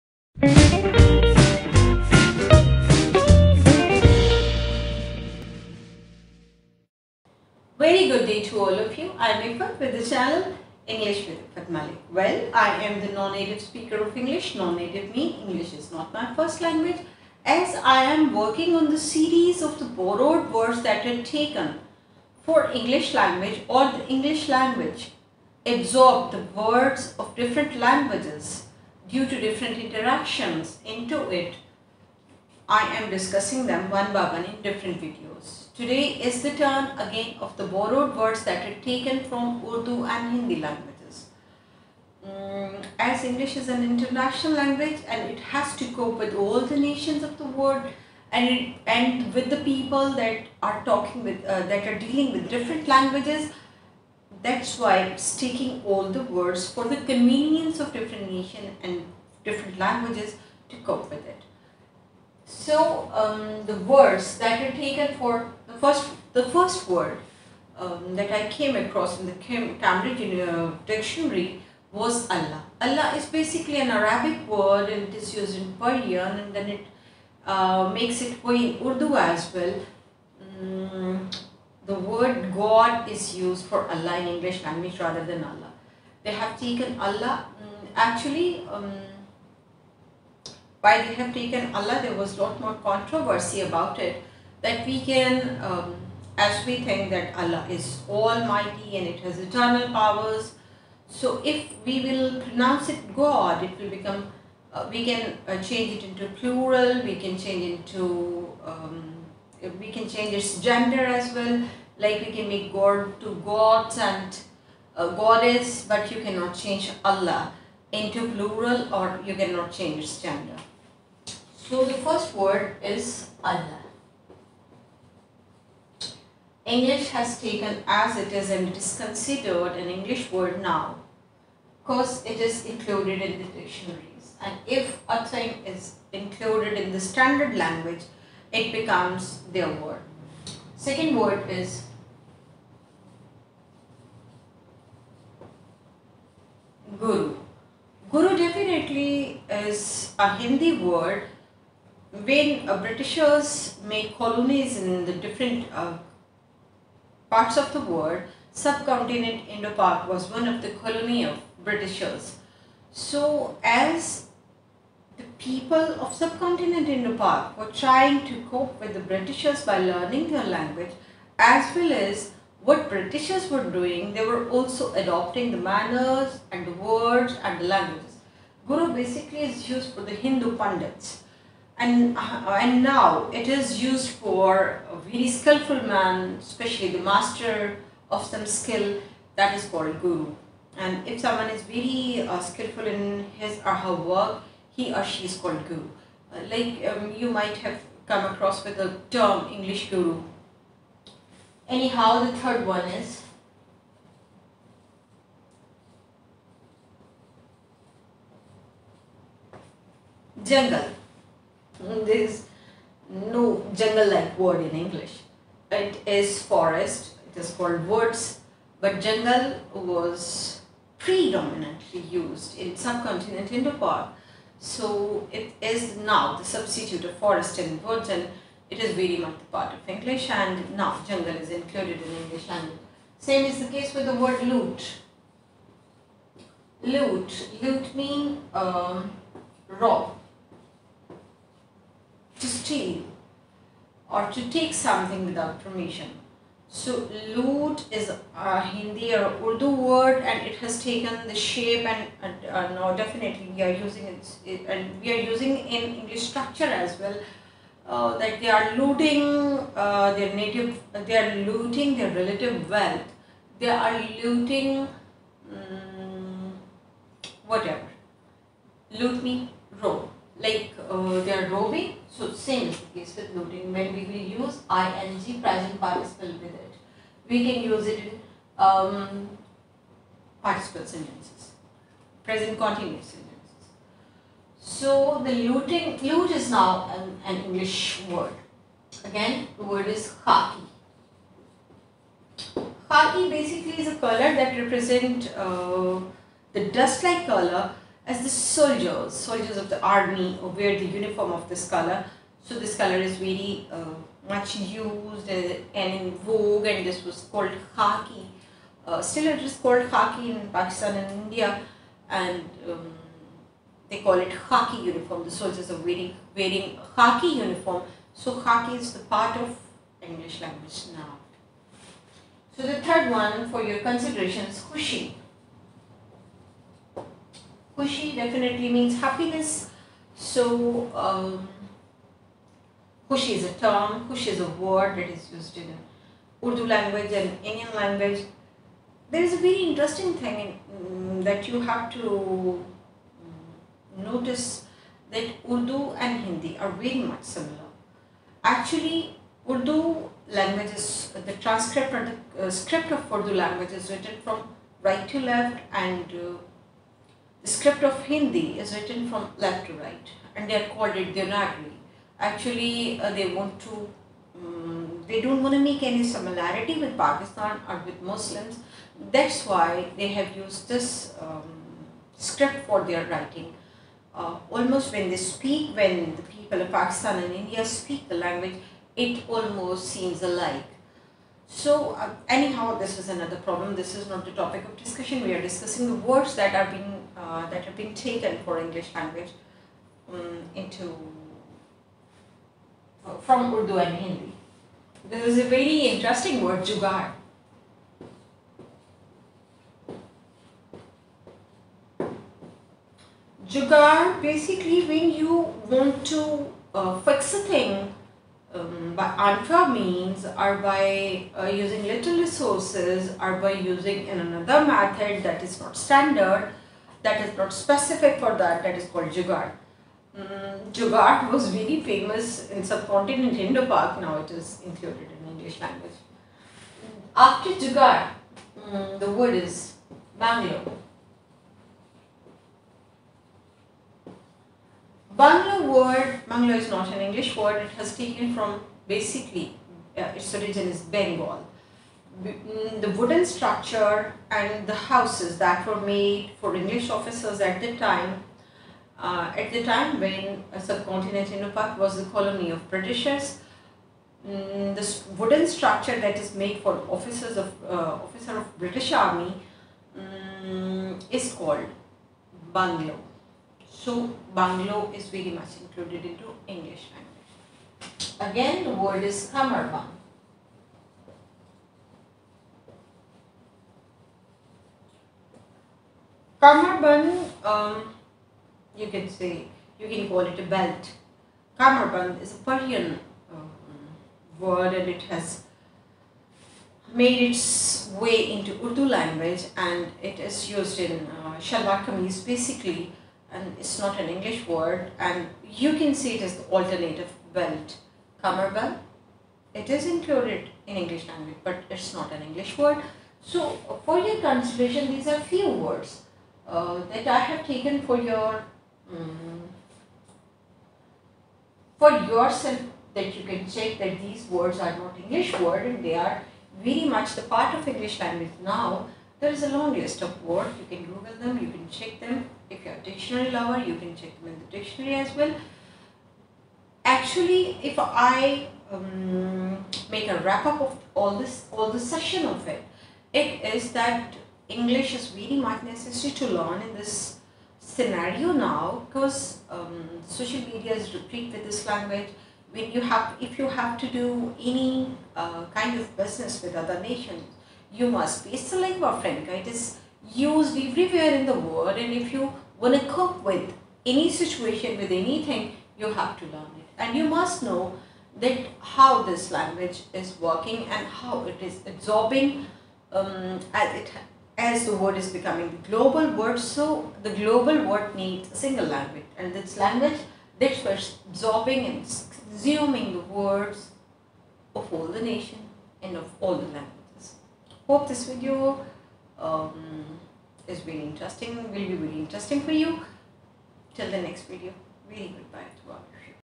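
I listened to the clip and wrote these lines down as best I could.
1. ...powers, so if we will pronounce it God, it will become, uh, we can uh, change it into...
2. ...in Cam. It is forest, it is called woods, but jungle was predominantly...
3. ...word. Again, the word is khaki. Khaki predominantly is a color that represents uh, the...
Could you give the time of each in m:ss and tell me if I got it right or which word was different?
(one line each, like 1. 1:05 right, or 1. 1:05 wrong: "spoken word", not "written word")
1. 1:39 right
2. 3:34 wrong: "English", not "Cam"
3. 4:48 wrong: "basically", not "predominantly".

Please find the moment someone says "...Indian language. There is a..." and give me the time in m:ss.
5:37.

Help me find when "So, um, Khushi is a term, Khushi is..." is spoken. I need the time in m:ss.
5:30.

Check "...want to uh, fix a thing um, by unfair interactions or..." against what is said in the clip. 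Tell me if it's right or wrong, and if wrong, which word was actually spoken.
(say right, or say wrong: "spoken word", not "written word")
wrong: "means", not "interactions".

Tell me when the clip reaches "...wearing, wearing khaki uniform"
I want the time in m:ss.
5:15.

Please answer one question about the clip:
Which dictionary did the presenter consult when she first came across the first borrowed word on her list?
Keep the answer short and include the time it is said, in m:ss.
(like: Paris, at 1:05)
Cambridge, at 1:09.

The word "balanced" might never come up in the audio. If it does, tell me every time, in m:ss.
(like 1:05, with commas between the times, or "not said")
not said.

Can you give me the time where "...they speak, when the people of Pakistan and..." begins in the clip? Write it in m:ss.
6:15.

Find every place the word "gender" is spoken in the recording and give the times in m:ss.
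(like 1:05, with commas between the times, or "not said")
1:50, 2:00.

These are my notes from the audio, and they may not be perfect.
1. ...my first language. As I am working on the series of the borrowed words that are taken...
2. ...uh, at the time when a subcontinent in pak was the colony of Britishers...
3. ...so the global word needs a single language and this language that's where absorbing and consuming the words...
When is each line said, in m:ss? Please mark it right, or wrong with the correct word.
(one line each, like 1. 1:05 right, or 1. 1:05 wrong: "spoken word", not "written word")
1. 0:16 right
2. 7:28 right
3. 9:26 right.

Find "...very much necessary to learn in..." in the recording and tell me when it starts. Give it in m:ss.
8:55.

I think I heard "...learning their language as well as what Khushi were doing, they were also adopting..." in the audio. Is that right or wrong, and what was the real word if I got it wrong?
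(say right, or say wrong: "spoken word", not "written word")
wrong: "Britishers", not "Khushi".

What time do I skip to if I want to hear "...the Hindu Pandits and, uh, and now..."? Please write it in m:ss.
3:00.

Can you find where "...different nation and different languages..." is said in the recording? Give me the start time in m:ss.
0:57.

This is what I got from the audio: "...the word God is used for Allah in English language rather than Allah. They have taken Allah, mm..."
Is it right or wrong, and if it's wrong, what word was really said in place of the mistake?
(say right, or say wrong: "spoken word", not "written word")
right.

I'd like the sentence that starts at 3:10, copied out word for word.
And if someone is very uh, skillful in his or her work, he or she is called guru.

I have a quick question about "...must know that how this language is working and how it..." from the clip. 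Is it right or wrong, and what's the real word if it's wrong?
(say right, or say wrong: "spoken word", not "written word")
right.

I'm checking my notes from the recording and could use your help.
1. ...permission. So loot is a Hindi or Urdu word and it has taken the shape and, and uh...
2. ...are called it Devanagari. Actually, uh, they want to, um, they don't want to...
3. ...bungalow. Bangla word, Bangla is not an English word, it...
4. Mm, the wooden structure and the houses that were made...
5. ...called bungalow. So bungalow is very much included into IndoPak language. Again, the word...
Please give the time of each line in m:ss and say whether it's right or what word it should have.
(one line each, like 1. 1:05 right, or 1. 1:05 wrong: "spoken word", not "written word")
1. 4:05 right
2. 6:00 right
3. 7:10 right
4. 7:22 right
5. 7:41 wrong: "English", not "IndoPak".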